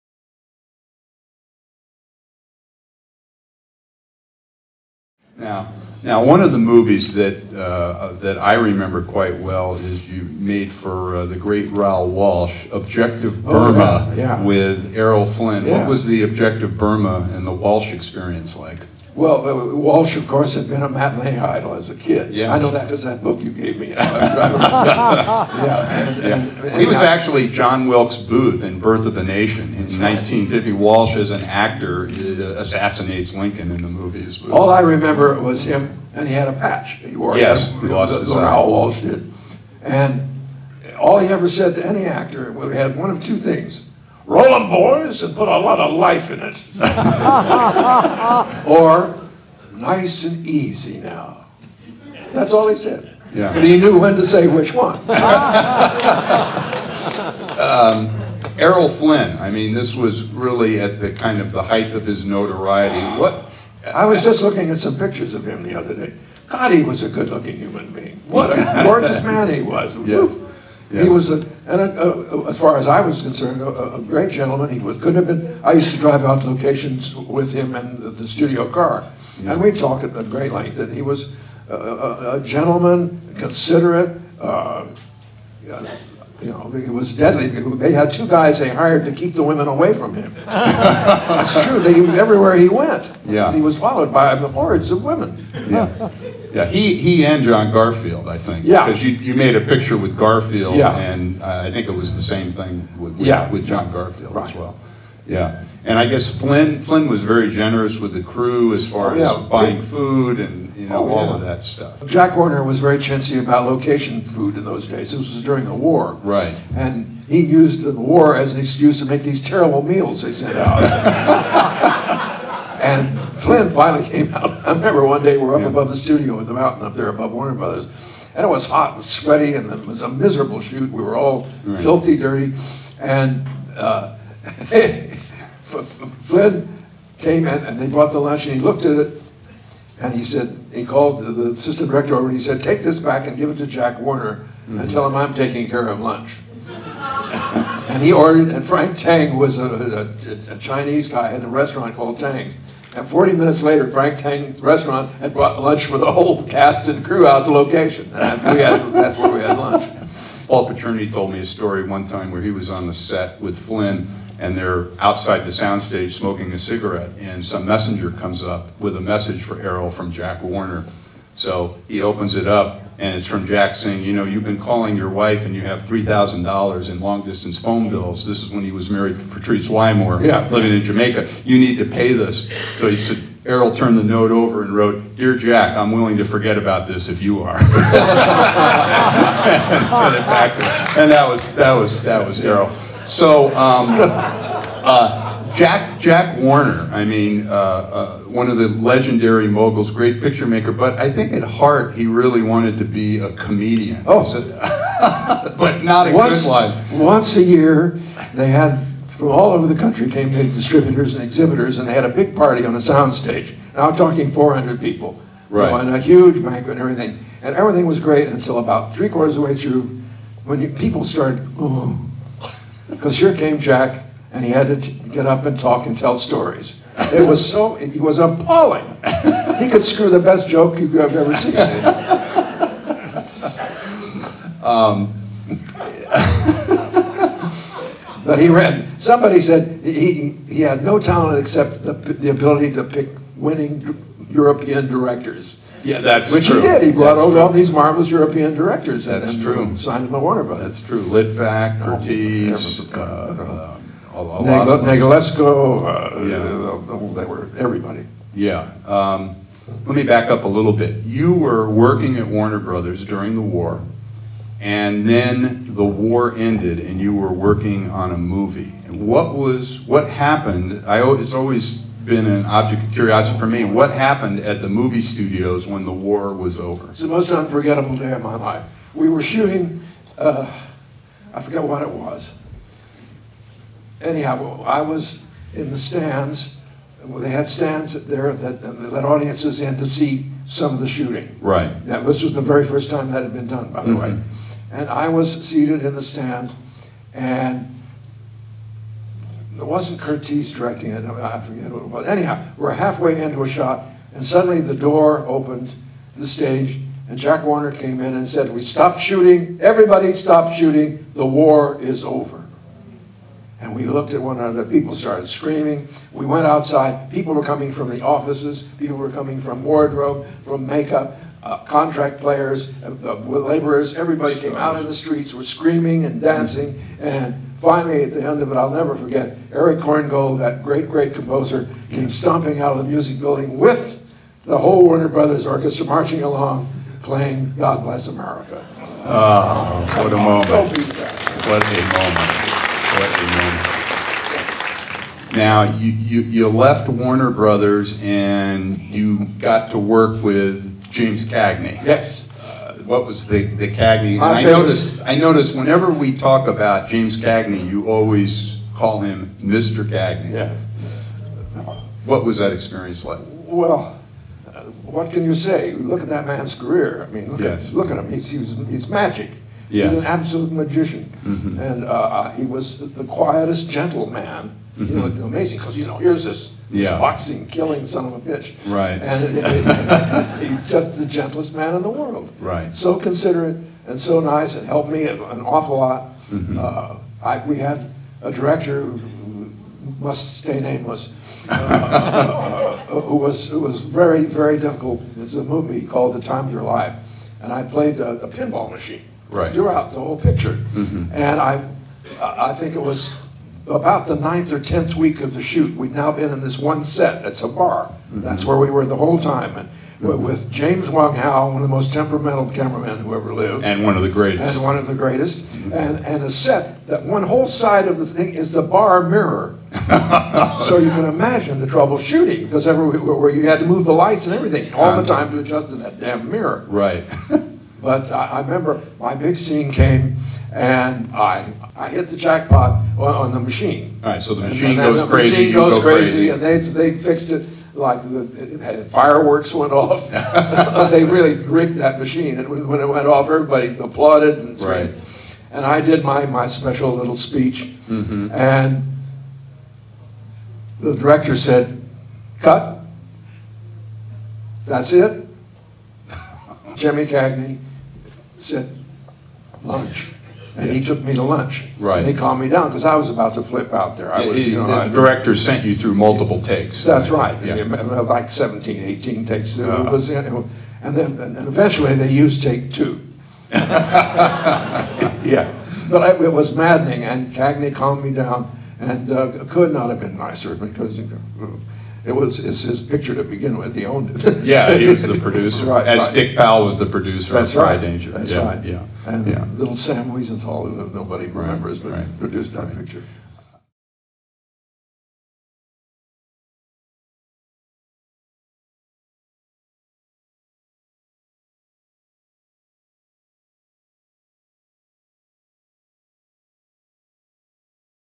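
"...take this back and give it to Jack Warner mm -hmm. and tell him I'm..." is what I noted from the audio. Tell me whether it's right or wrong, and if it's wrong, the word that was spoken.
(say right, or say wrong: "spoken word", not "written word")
right.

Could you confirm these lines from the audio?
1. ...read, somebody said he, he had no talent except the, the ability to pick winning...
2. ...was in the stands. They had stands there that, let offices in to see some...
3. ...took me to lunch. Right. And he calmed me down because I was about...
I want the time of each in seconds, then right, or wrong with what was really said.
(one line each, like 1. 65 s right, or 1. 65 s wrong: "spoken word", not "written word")
1. 238 s right
2. 284 s wrong: "audiences", not "offices"
3. 460 s right.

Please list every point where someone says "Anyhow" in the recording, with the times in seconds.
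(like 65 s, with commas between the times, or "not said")
284 s, 302 s.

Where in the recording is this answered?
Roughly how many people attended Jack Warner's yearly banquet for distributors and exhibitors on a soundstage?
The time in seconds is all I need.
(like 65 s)
214 s.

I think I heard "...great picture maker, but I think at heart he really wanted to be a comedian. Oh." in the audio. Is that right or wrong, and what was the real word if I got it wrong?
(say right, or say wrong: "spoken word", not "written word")
right.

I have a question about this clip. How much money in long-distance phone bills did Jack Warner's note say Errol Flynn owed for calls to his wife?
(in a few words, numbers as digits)
$3,000.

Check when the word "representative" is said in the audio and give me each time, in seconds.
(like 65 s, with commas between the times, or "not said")
not said.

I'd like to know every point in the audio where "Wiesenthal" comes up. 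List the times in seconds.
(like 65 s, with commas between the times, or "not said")
490 s.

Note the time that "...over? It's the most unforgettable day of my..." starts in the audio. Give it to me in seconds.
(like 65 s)
276 s.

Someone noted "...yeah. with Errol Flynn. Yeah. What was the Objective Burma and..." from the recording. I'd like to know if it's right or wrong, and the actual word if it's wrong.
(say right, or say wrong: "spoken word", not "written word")
right.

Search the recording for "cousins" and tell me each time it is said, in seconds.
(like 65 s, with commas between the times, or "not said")
not said.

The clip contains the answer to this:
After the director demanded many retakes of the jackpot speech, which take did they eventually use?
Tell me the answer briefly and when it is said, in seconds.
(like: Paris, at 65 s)
Take 2, at 472 s.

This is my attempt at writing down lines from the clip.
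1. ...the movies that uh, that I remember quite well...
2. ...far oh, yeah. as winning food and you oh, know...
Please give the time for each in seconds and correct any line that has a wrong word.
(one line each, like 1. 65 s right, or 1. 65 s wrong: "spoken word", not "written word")
1. 6 s right
2. 108 s wrong: "buying", not "winning".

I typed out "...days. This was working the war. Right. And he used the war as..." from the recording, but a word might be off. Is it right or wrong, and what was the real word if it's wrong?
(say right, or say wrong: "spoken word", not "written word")
wrong: "during", not "working".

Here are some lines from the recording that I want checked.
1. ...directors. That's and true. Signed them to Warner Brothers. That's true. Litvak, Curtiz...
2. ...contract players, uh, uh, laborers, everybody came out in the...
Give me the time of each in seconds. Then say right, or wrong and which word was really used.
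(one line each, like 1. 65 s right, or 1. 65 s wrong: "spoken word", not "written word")
1. 248 s right
2. 321 s right.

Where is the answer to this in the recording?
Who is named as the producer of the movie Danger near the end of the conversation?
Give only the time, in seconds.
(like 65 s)
486 s.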